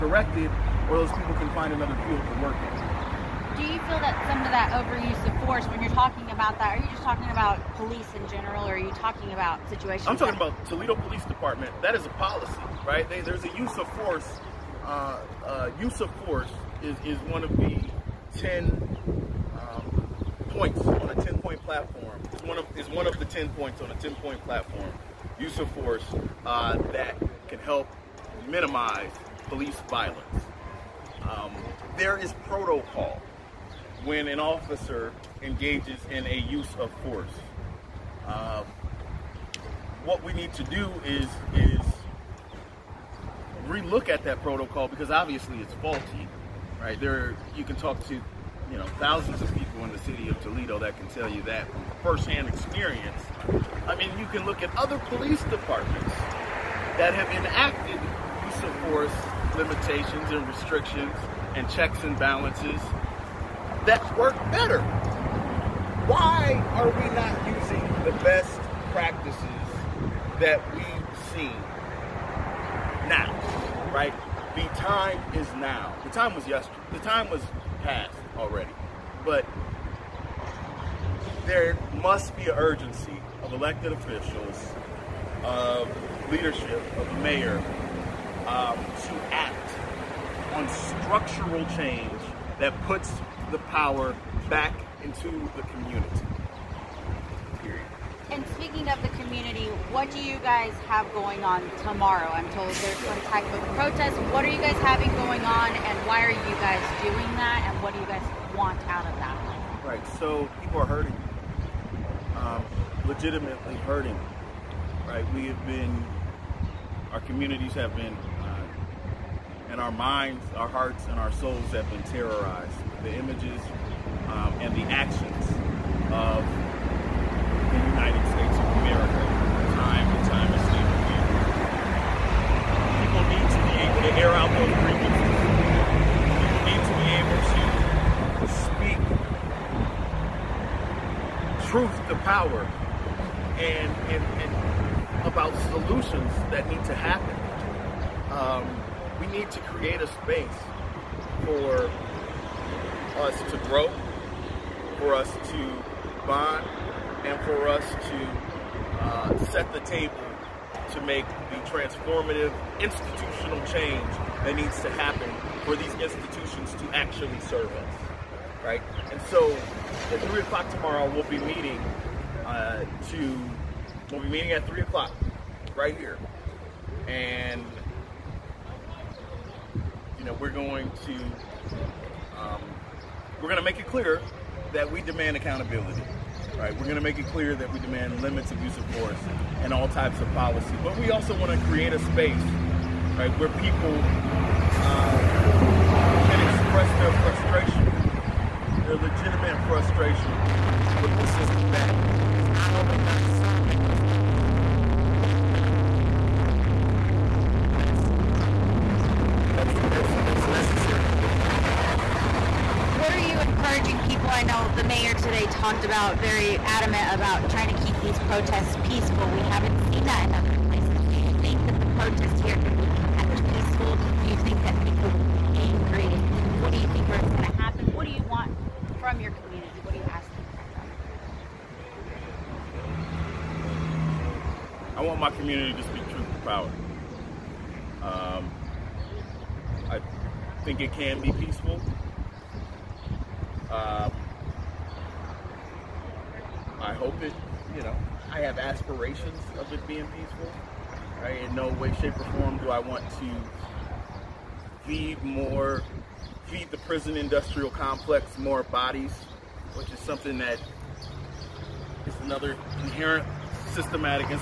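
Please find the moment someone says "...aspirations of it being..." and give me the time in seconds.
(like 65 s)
248 s.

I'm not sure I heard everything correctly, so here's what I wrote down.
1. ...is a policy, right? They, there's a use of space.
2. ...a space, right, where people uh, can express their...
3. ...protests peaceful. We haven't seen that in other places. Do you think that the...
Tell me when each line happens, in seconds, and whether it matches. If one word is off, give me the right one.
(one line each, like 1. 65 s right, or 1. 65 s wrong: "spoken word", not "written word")
1. 11 s wrong: "force", not "space"
2. 191 s right
3. 218 s right.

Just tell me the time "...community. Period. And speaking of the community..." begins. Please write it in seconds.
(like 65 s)
95 s.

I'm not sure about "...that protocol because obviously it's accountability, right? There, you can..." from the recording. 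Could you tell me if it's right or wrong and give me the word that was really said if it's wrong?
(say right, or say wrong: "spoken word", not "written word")
wrong: "faulty", not "accountability".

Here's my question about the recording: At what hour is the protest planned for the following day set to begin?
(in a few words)
3 o'clock.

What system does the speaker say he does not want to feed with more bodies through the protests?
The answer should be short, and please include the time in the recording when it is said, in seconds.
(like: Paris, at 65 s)
prison industrial complex, at 256 s.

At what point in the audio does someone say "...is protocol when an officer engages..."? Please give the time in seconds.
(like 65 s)
32 s.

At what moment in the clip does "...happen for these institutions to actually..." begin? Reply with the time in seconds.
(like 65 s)
164 s.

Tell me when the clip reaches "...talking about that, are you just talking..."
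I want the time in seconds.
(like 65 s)
5 s.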